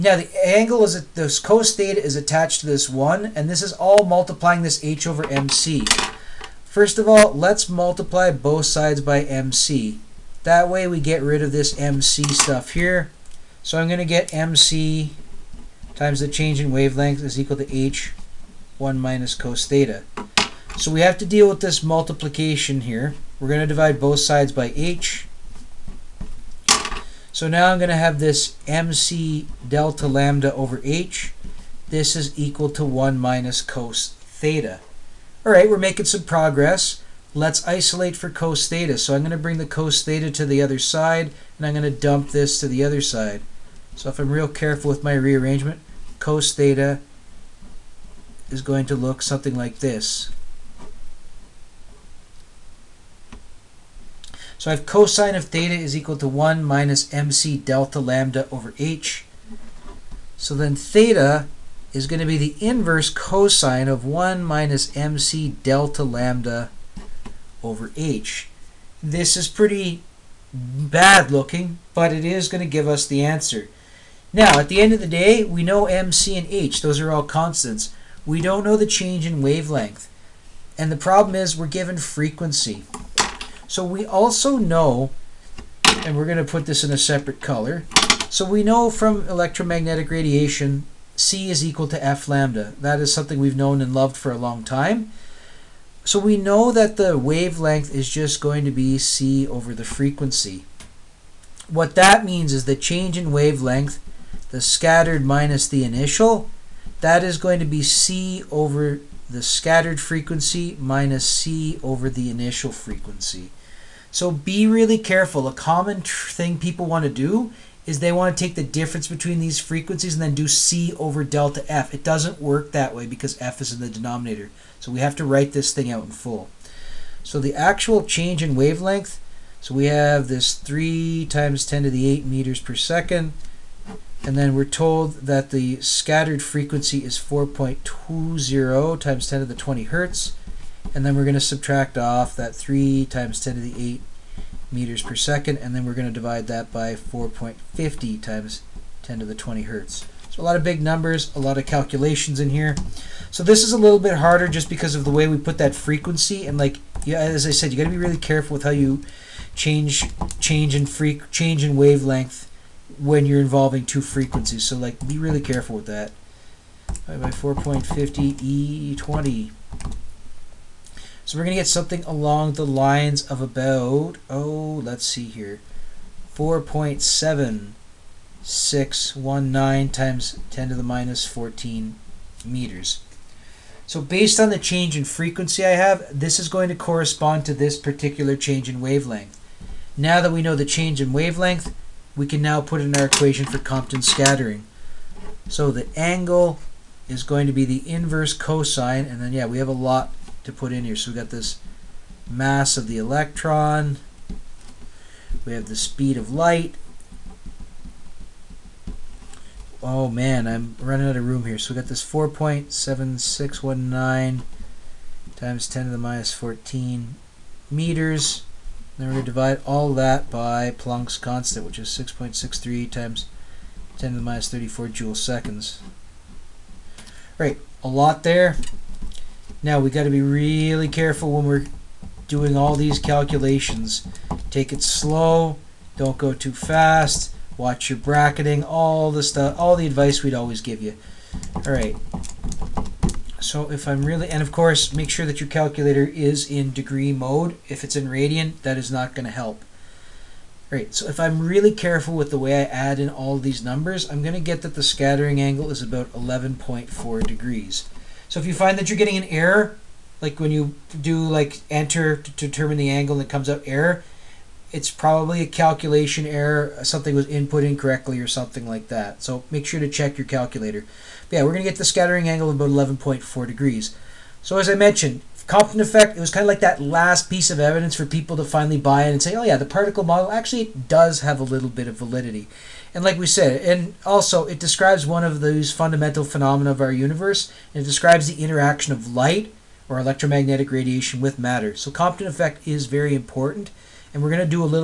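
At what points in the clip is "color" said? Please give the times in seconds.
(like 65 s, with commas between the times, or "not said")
87 s.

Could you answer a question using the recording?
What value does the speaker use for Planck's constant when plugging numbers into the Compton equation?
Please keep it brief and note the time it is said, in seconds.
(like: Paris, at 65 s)
6.63 x 10^-34 J·s, at 221 s.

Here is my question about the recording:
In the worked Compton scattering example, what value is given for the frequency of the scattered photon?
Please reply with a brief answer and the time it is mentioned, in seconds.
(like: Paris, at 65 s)
4.20 x 10^20 Hz, at 137 s.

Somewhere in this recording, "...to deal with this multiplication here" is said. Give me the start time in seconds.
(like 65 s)
21 s.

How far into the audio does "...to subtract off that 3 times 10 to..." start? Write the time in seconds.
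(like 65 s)
141 s.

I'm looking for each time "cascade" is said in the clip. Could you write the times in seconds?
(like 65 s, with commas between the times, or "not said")
not said.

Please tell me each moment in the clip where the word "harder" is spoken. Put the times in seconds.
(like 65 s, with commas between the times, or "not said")
154 s.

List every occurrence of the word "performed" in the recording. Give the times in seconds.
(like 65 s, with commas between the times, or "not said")
not said.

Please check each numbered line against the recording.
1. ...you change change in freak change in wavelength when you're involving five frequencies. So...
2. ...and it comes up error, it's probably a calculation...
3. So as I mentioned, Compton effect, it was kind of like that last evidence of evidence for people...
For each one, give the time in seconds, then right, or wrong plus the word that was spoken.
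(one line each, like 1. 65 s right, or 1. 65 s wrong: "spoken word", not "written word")
1. 158 s wrong: "two", not "five"
2. 263 s right
3. 274 s wrong: "piece", not "evidence".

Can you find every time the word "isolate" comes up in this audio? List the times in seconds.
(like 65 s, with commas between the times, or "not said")
37 s.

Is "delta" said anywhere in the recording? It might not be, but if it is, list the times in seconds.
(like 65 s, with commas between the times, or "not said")
29 s, 57 s, 65 s, 121 s.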